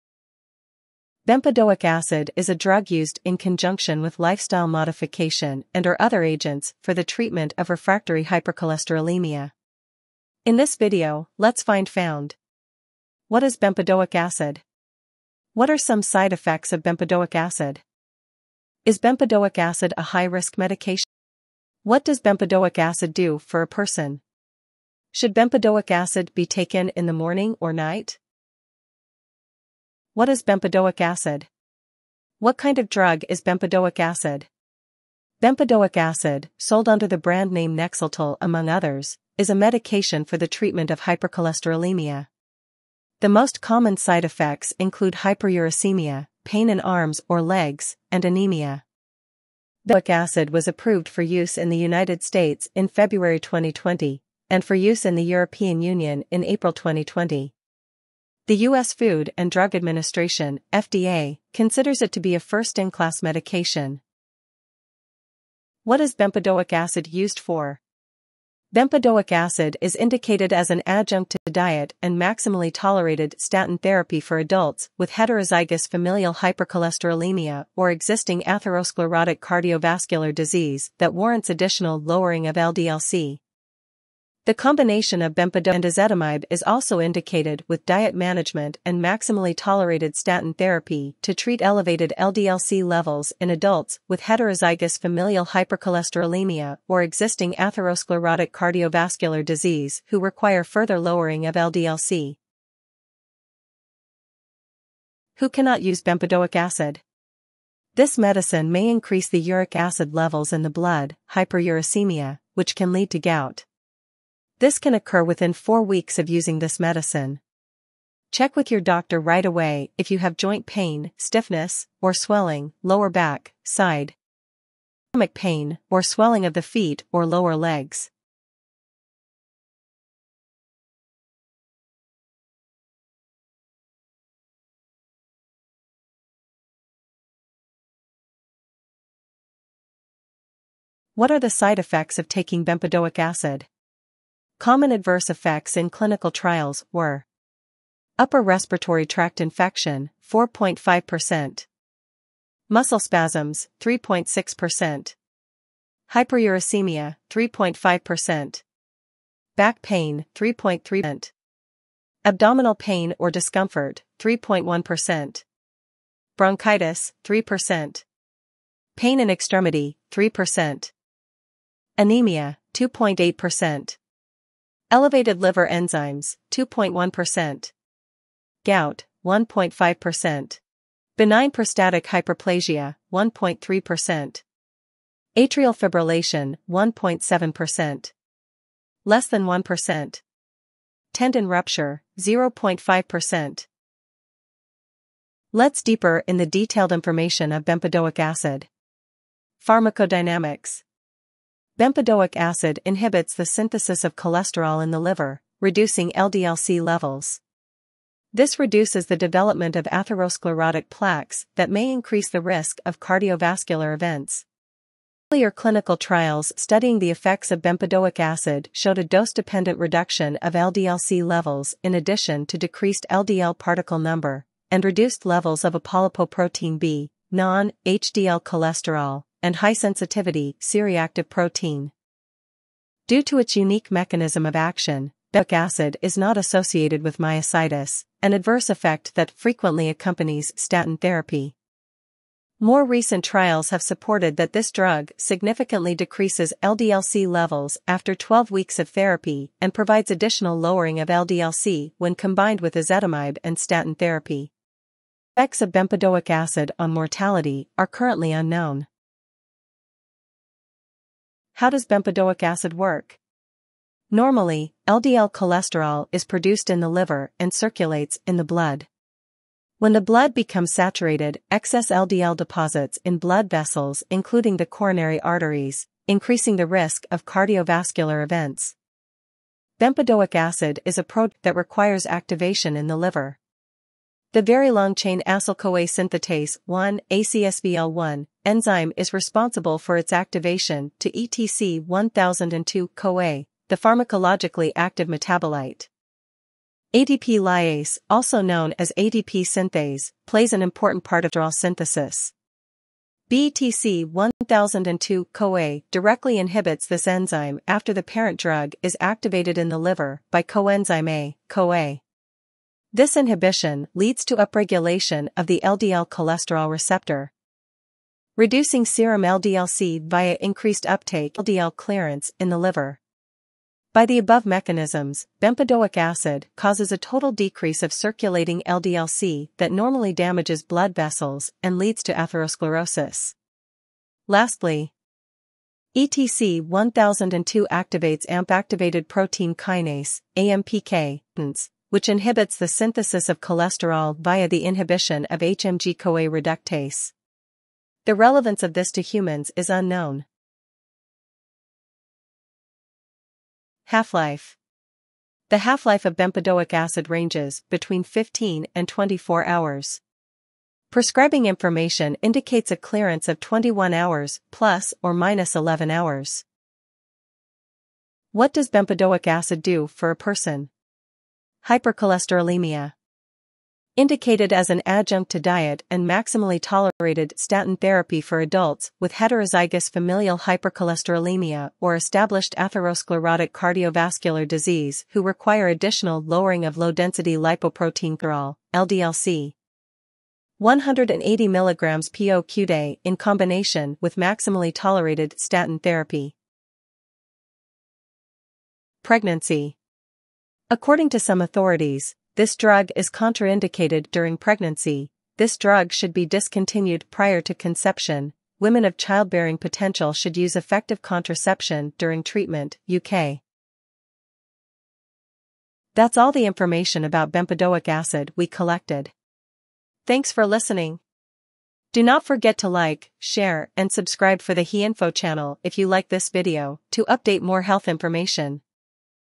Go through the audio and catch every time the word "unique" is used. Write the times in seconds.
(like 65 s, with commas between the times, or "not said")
233 s.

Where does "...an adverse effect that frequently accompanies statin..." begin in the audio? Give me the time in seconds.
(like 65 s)
238 s.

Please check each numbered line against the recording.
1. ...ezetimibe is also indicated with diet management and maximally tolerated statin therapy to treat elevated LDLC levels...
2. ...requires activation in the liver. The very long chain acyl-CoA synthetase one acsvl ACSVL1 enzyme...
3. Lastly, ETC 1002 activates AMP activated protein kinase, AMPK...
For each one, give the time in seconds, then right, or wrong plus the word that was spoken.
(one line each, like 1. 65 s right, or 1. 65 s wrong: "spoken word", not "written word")
1. 85 s right
2. 281 s right
3. 334 s right.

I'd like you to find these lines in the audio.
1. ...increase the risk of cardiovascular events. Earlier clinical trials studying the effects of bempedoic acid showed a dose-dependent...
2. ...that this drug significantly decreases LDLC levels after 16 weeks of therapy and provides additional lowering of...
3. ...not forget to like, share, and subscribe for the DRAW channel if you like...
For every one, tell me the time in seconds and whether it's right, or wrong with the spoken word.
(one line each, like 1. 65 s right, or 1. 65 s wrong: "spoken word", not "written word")
1. 211 s right
2. 244 s wrong: "12", not "16"
3. 422 s wrong: "HeInfo", not "DRAW".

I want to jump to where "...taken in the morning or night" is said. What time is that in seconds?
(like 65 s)
26 s.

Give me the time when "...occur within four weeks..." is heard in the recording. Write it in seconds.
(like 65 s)
114 s.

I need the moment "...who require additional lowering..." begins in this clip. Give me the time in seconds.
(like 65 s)
385 s.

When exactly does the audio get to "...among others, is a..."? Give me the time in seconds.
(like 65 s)
38 s.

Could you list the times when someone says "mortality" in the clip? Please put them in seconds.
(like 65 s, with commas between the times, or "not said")
256 s.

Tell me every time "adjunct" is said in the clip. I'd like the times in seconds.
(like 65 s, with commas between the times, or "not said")
70 s, 374 s.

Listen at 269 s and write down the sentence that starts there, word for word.
When the blood becomes saturated, excess LDL deposits in blood vessels including the coronary arteries, increasing the risk of cardiovascular events.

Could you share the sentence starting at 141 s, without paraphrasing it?
What are the side effects of taking bempedoic acid?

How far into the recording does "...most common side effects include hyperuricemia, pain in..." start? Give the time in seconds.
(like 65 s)
43 s.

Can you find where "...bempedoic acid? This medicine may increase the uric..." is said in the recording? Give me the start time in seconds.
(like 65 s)
106 s.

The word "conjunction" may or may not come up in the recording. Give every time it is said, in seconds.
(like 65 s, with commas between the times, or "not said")
3 s.